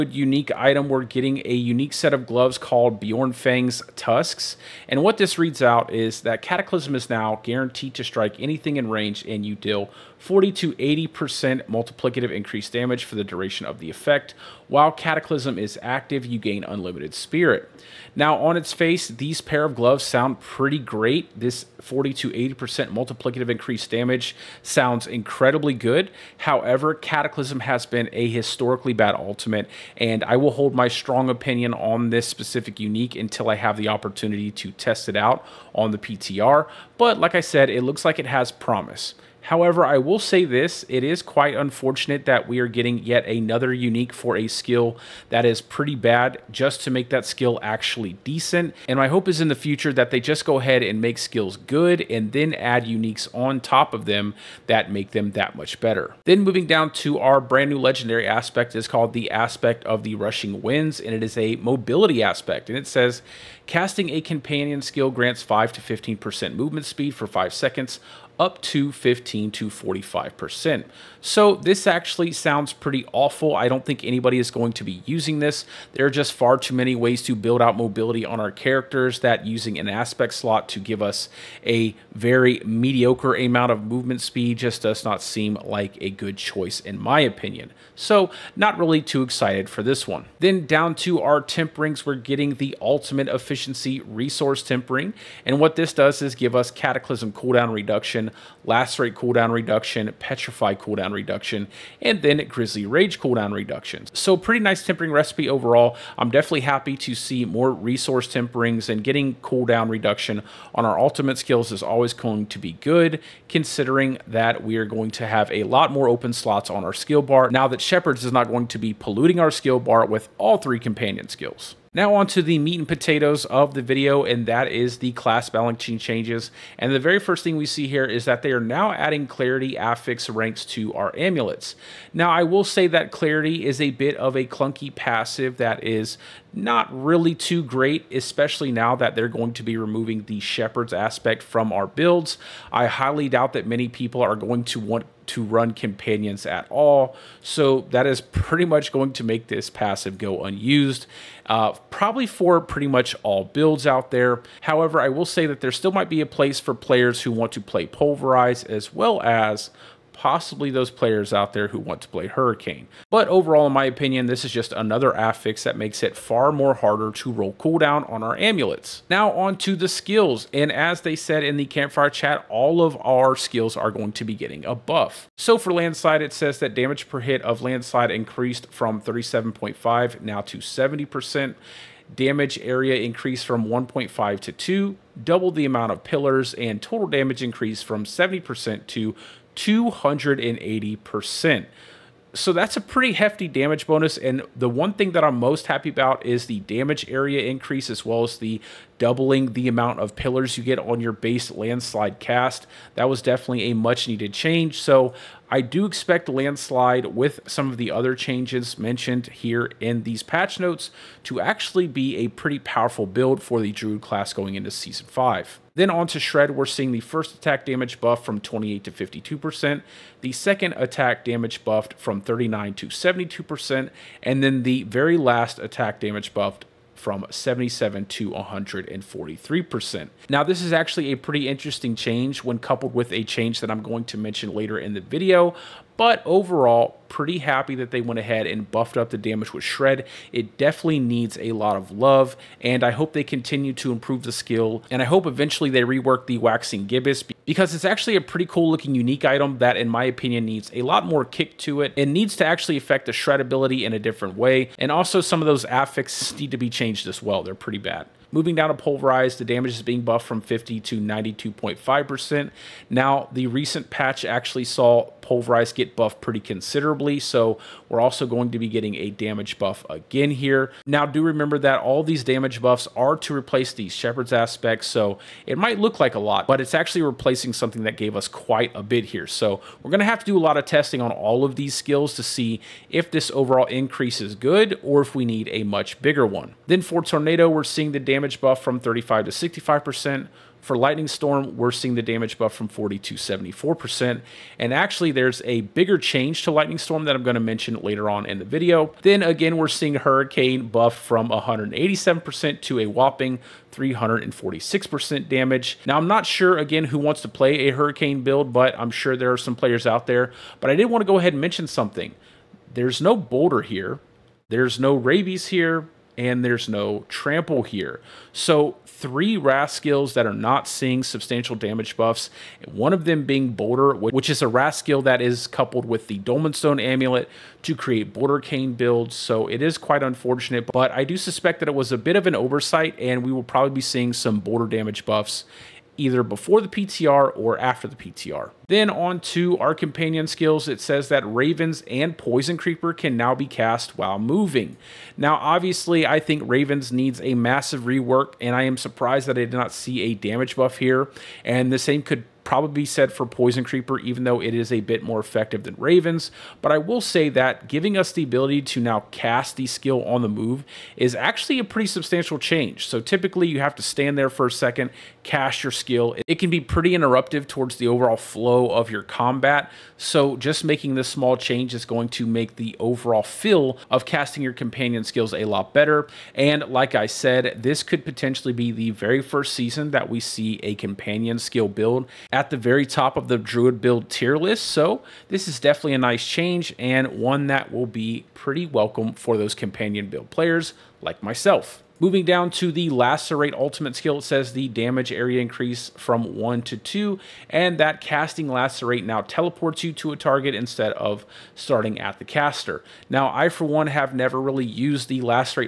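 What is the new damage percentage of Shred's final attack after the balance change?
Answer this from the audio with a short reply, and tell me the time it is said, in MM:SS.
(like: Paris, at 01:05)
143%, at 03:48.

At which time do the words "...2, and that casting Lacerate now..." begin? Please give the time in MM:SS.
06:36.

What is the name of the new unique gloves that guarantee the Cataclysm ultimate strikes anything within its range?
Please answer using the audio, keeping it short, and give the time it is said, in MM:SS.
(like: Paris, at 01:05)
Bjornfang's Tusks, at 00:02.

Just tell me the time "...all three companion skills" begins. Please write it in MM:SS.
02:00.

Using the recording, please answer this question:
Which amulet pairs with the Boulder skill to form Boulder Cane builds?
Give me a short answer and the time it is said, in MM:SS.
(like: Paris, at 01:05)
Dolmenstone Amulet, at 05:26.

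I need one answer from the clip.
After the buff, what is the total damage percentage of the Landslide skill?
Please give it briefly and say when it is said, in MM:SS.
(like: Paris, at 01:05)
280%, at 03:09.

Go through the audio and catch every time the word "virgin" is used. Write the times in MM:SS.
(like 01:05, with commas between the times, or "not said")
not said.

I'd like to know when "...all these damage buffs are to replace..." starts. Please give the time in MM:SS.
04:31.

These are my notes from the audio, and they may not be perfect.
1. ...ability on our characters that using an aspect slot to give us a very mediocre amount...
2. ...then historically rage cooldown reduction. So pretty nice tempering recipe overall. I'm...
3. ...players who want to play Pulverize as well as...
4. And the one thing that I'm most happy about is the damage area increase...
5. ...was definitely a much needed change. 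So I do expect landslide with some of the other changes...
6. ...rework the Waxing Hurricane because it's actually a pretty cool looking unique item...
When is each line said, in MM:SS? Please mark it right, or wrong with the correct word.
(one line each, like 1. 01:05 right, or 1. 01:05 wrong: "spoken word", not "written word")
1. 01:17 wrong: "mobility", not "ability"
2. 01:42 wrong: "grizzly", not "historically"
3. 02:36 right
4. 03:14 right
5. 03:23 right
6. 04:05 wrong: "Gibbous", not "Hurricane".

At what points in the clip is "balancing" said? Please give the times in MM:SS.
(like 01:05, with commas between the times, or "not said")
02:05.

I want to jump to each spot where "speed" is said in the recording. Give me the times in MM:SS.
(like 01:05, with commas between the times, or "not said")
01:06, 01:24.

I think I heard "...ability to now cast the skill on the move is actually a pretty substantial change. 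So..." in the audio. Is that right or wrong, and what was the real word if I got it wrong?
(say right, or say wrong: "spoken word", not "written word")
right.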